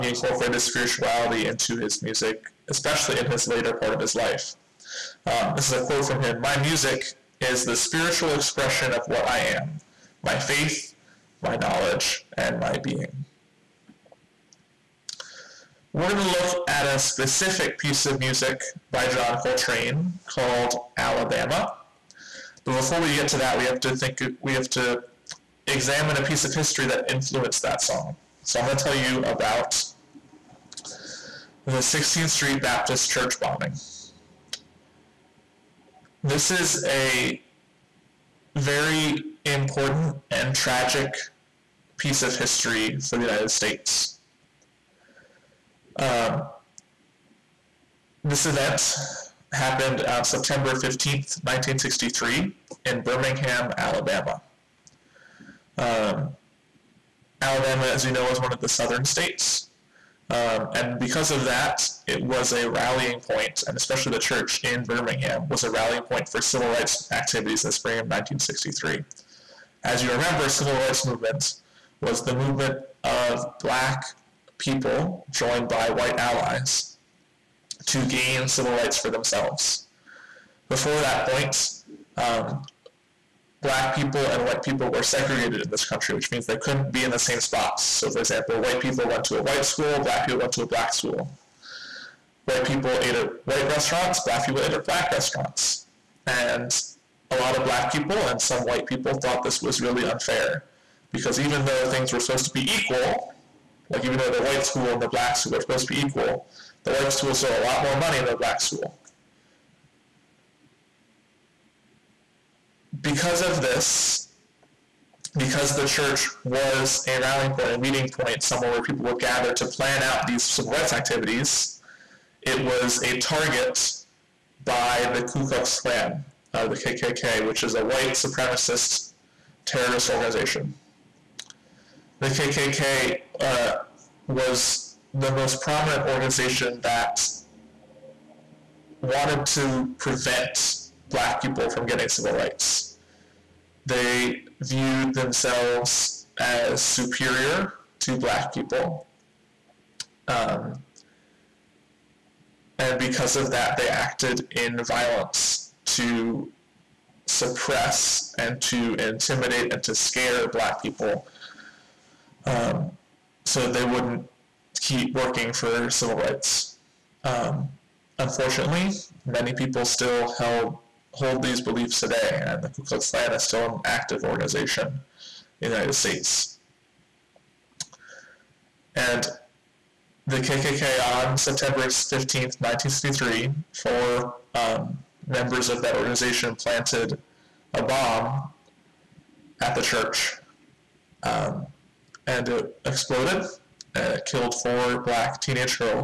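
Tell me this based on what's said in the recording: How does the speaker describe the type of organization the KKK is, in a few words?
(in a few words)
White supremacist terrorist organization.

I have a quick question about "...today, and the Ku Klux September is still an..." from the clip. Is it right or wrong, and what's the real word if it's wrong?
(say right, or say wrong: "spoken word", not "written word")
wrong: "Klan", not "September".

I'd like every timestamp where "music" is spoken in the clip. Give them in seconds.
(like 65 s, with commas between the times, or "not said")
2 s, 6 s, 18 s.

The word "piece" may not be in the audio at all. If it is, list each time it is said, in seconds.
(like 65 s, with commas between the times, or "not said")
17 s, 26 s, 41 s.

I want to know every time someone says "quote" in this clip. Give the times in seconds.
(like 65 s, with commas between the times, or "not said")
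5 s.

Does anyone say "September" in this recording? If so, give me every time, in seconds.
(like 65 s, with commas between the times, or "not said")
50 s, 181 s.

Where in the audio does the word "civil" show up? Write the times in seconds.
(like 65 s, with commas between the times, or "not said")
66 s, 70 s, 78 s, 120 s, 142 s, 165 s.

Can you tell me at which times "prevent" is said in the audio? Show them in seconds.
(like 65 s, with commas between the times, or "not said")
139 s.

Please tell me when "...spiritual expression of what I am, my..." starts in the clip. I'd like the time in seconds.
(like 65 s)
7 s.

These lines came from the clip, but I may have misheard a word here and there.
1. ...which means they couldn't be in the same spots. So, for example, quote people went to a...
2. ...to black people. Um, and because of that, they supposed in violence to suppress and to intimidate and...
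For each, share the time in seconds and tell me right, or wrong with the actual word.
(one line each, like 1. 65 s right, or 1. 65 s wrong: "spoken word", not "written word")
1. 86 s wrong: "white", not "quote"
2. 148 s wrong: "acted", not "supposed".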